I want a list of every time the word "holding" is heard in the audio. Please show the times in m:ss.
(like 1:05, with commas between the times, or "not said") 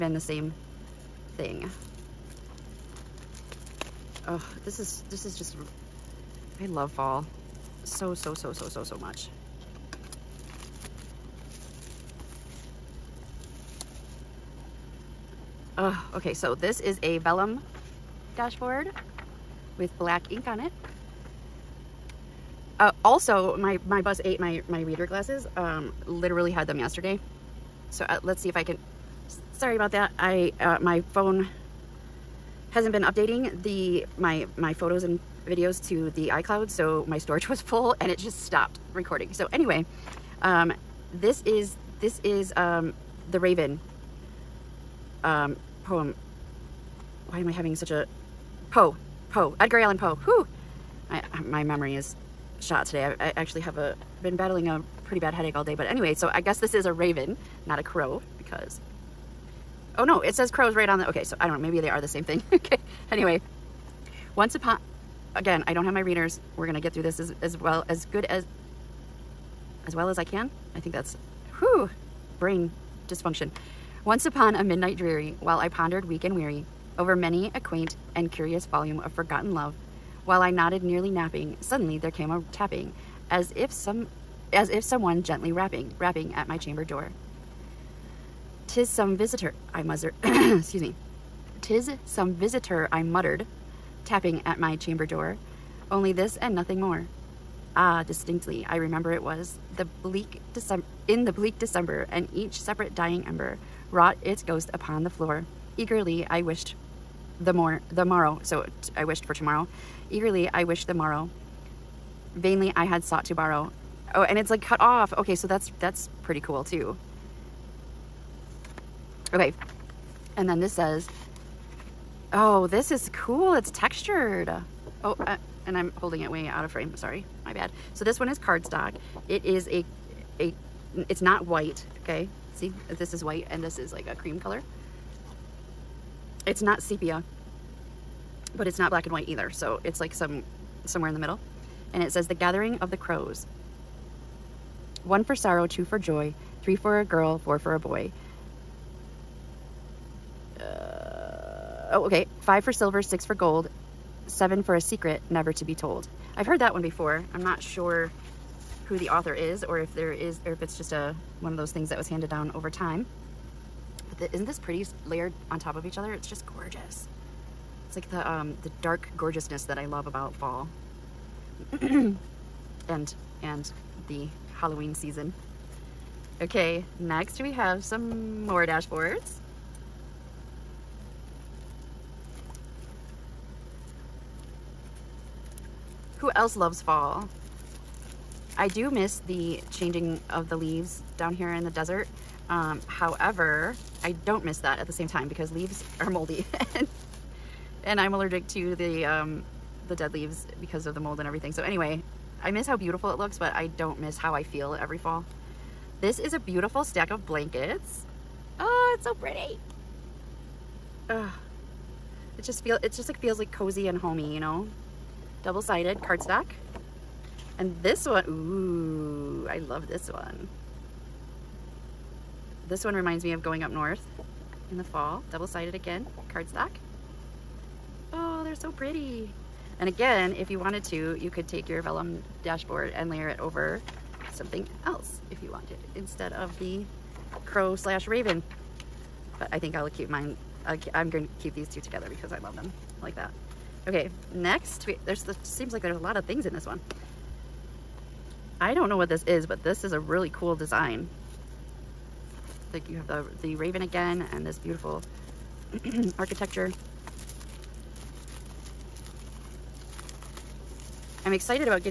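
2:06.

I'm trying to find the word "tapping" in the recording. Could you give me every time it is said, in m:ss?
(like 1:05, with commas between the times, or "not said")
1:22, 1:34.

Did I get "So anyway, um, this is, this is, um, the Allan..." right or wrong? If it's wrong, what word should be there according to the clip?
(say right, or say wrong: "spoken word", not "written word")
wrong: "Raven", not "Allan".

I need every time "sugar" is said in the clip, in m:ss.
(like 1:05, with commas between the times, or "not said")
not said.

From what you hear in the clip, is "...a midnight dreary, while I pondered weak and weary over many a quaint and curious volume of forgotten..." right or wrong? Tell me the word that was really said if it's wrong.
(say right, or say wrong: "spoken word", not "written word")
right.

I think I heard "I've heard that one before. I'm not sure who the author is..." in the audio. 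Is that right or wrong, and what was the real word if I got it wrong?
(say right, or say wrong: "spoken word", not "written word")
right.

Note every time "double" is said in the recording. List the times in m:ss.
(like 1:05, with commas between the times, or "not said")
3:35, 3:45.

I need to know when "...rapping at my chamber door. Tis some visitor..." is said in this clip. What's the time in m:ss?
1:25.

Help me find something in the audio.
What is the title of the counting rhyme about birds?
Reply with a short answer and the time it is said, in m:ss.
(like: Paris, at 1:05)
The Gathering of the Crows, at 2:22.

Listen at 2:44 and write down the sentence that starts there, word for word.
But the, isn't this pretty layered on top of each other?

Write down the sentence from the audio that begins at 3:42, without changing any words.
This one reminds me of going up north in the fall.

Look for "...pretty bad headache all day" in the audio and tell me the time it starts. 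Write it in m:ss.
0:55.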